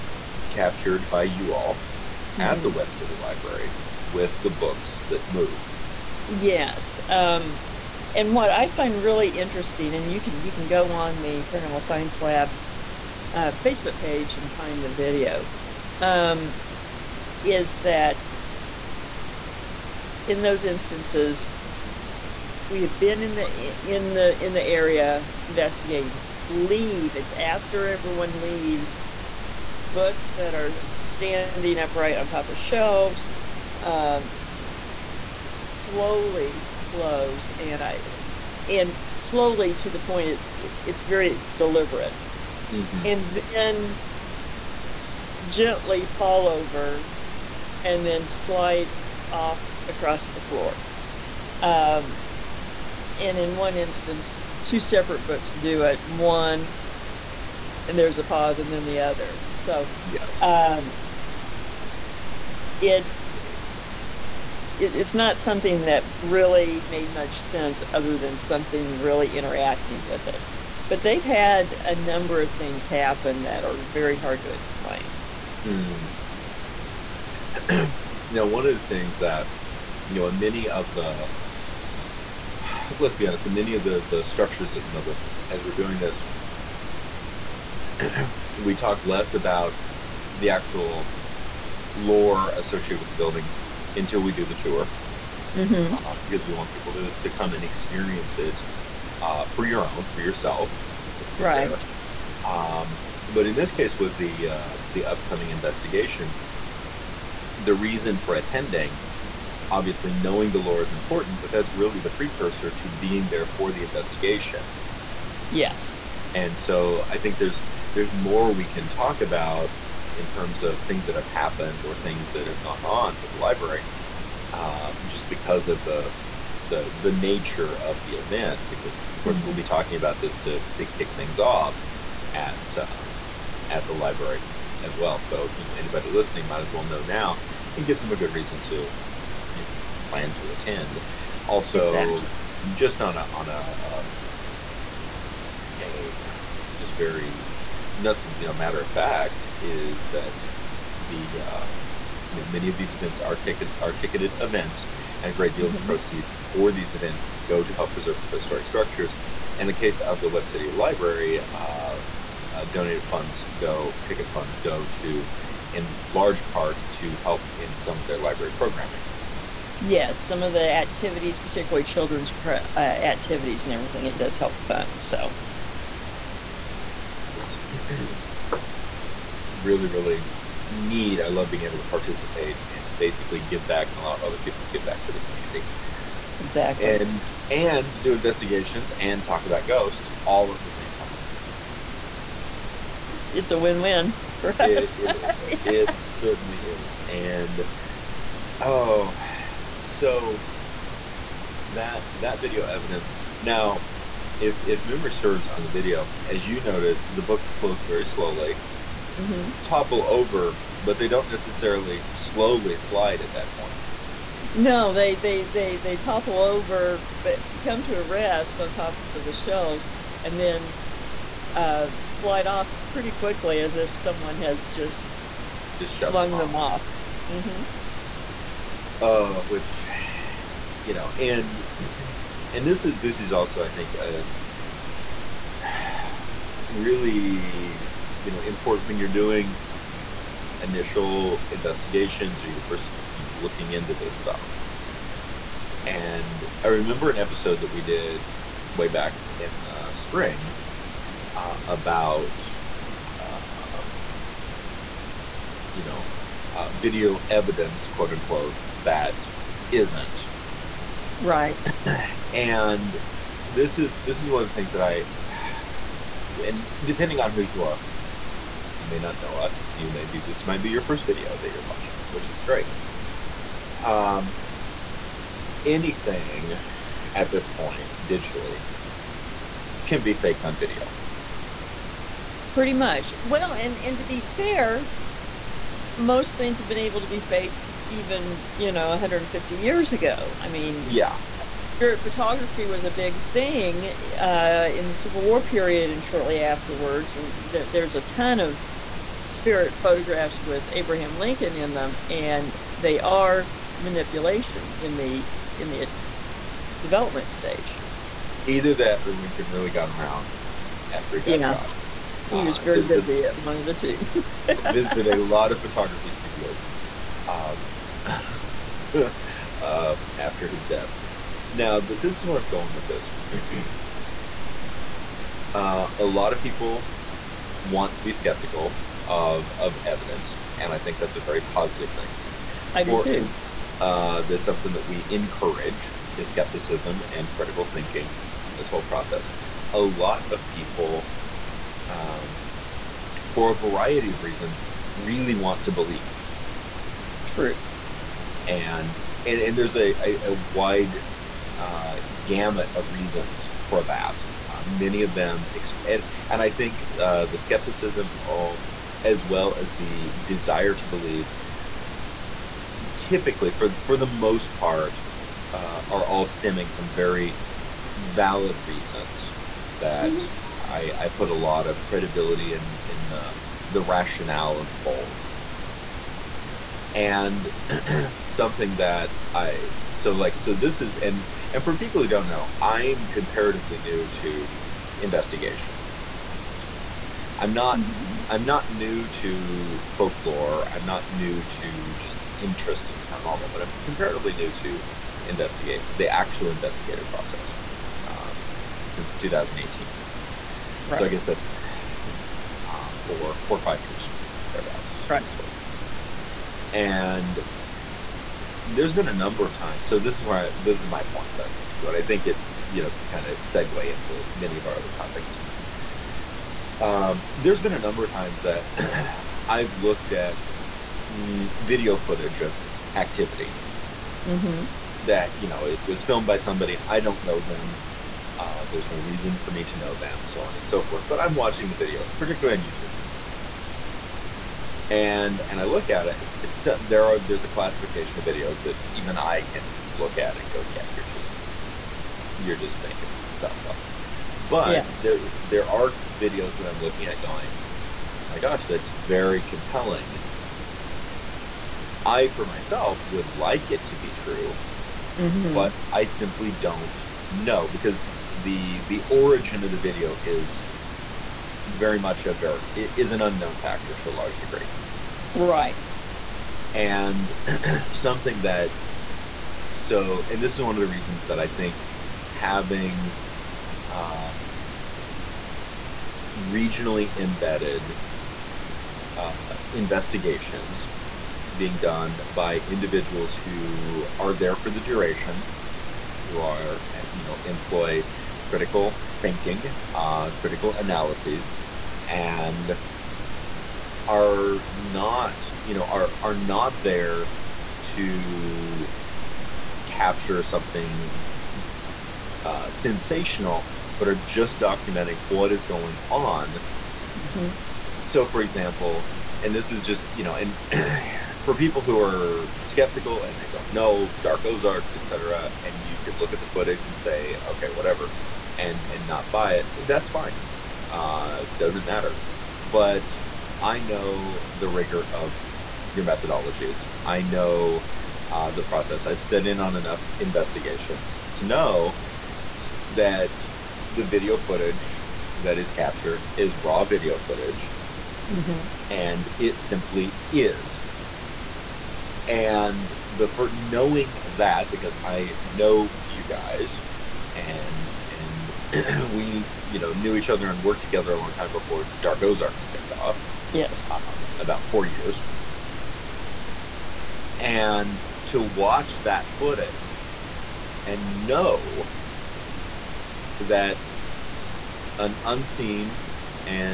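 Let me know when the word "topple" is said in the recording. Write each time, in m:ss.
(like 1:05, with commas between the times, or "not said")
3:29, 3:35.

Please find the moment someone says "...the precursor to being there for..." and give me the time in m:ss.
1:51.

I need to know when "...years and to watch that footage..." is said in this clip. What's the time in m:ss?
9:14.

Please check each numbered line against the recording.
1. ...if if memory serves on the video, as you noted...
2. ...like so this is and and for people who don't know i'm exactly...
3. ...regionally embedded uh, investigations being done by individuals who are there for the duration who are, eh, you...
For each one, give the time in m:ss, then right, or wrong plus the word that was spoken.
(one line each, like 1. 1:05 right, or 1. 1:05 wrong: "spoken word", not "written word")
1. 3:24 right
2. 6:20 wrong: "comparatively", not "exactly"
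3. 7:56 right.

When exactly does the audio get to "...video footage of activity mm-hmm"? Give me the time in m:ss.
7:01.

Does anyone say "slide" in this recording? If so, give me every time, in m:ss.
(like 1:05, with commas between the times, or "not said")
0:48, 3:32, 3:42.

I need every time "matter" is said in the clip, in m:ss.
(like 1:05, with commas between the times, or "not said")
2:28, 8:41.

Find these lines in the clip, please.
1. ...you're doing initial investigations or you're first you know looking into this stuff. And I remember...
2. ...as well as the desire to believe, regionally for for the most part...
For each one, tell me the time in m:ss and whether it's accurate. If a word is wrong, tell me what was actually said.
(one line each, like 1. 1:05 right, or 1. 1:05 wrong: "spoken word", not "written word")
1. 3:58 right
2. 5:59 wrong: "typically", not "regionally".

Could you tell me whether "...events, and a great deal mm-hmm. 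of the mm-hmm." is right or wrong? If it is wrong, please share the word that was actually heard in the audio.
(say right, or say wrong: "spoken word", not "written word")
right.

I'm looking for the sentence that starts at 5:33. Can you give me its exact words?
Uh, that's something that we encourage is skepticism and critical thinking in this whole process.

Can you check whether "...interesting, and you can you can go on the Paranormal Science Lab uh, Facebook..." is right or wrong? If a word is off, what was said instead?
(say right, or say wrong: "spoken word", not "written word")
right.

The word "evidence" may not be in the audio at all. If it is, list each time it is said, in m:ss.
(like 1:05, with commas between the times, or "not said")
3:22, 4:17, 5:29.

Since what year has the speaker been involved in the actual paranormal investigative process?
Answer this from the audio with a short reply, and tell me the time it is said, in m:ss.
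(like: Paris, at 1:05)
2018, at 6:39.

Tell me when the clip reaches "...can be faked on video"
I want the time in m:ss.
4:39.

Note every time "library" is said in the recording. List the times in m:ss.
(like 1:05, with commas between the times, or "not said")
0:03, 2:03, 2:13, 2:40, 2:48.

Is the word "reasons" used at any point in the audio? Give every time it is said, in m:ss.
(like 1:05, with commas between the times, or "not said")
1:47, 2:18, 5:44, 5:52, 6:08, 7:08, 7:50.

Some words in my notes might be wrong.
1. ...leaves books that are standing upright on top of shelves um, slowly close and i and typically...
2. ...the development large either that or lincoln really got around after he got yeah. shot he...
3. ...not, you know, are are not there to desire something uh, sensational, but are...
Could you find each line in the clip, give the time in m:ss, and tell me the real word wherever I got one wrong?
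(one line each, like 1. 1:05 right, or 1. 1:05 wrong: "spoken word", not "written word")
1. 0:28 wrong: "slowly", not "typically"
2. 5:05 wrong: "stage", not "large"
3. 8:14 wrong: "capture", not "desire".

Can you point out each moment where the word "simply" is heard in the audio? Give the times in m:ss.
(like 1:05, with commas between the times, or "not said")
7:36, 8:59.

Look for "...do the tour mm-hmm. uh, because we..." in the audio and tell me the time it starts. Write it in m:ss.
1:34.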